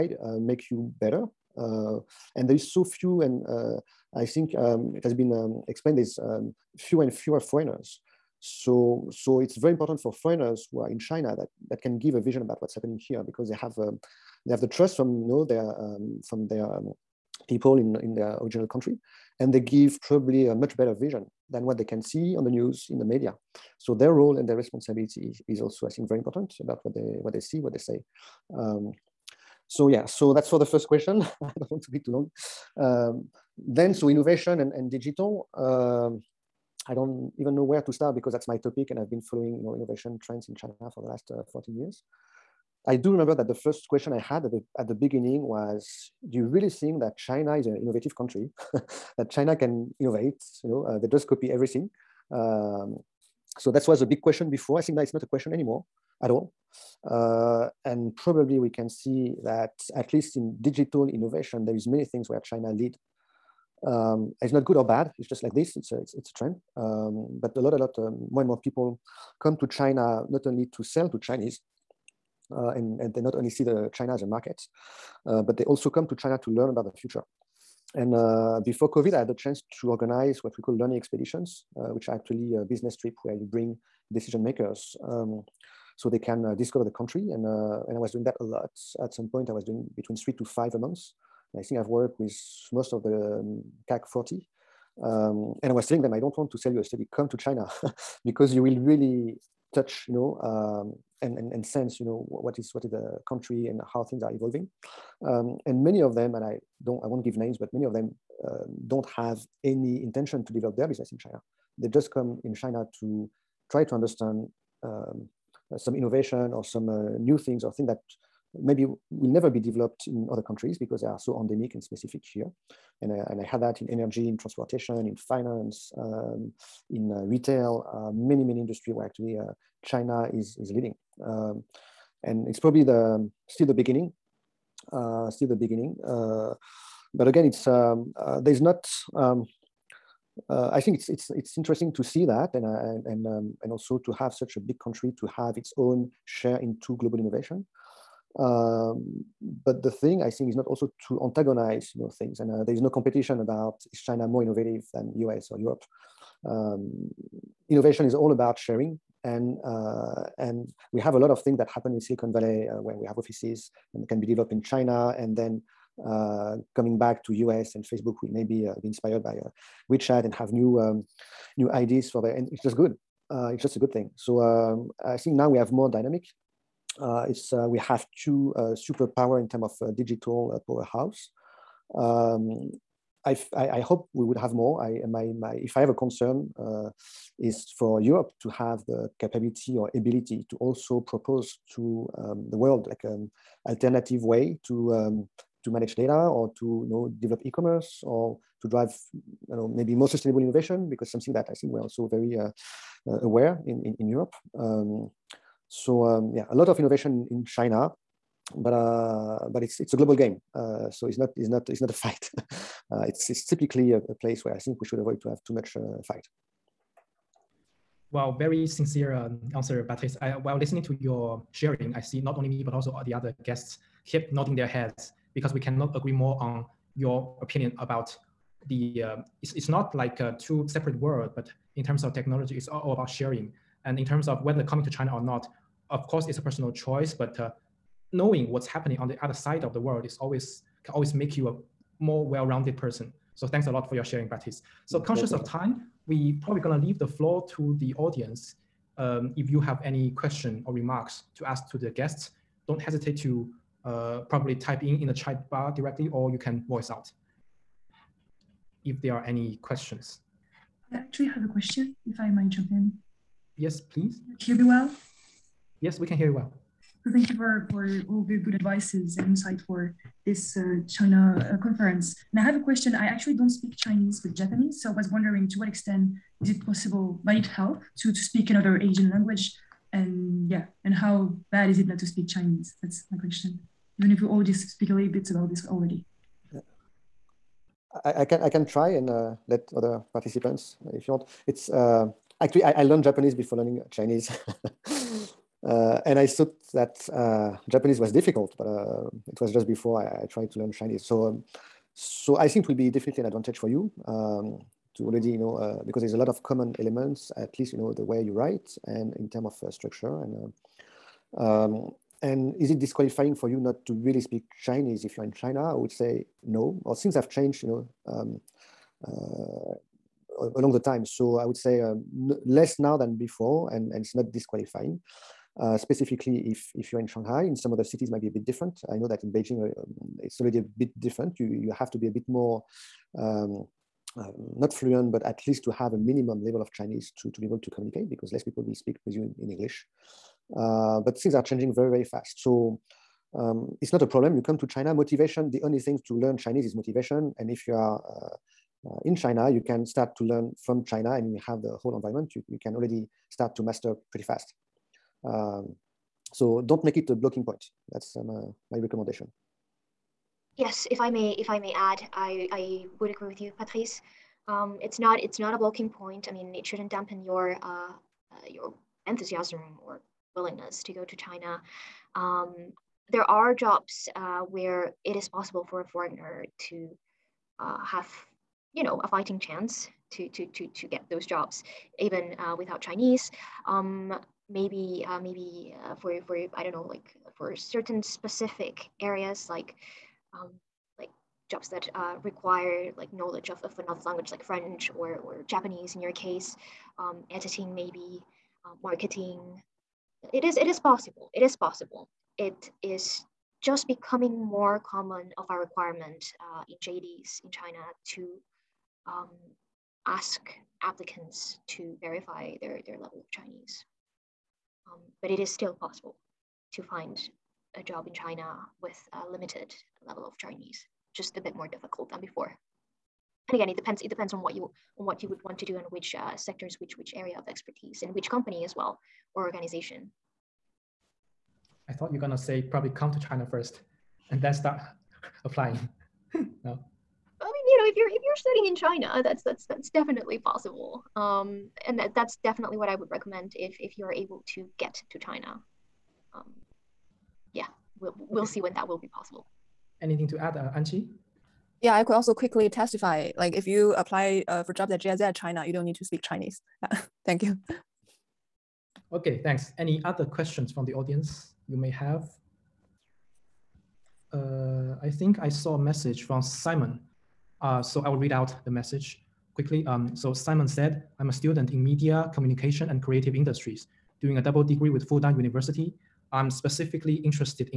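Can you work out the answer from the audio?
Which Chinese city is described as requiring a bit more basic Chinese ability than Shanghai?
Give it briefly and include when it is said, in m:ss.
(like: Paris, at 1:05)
Beijing, at 5:29.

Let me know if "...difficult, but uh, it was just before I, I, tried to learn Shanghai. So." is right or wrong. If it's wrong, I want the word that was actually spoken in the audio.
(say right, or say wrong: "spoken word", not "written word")
wrong: "Chinese", not "Shanghai".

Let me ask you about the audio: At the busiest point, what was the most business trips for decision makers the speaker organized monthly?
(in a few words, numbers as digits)
5.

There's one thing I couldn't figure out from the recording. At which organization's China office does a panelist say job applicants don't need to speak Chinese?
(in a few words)
GIZ.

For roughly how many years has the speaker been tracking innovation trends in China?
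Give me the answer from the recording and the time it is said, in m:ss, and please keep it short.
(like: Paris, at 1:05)
14 years, at 0:41.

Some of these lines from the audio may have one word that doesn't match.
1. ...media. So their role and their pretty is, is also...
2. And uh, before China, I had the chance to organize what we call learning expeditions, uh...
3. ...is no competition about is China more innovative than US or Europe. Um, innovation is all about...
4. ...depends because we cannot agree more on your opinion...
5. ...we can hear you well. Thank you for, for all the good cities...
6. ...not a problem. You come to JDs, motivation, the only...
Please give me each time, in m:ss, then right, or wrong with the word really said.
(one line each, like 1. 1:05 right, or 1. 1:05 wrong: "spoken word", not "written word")
1. 0:23 wrong: "responsibility", not "pretty"
2. 1:17 wrong: "COVID", not "China"
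3. 2:32 right
4. 3:44 wrong: "heads", not "depends"
5. 4:25 wrong: "advices", not "cities"
6. 5:43 wrong: "China", not "JDs".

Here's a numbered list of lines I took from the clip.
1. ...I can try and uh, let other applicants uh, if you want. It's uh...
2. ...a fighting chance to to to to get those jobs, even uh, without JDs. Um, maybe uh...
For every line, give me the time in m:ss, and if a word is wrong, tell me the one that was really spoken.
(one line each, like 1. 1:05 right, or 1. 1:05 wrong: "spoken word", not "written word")
1. 4:48 wrong: "participants", not "applicants"
2. 6:19 wrong: "Chinese", not "JDs".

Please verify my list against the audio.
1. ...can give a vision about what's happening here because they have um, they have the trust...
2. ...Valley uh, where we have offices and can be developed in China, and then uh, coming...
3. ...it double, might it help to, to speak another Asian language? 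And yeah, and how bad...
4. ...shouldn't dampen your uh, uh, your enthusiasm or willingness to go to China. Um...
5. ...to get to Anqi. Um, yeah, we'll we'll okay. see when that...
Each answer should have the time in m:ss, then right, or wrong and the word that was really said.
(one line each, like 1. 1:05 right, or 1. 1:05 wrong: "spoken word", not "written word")
1. 0:11 right
2. 2:42 right
3. 4:36 wrong: "possible", not "double"
4. 6:06 right
5. 7:24 wrong: "China", not "Anqi".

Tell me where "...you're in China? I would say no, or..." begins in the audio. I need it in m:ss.
5:15.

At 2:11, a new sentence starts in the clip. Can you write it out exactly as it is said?
Um, and it's probably the um, still the beginning, uh, still the beginning.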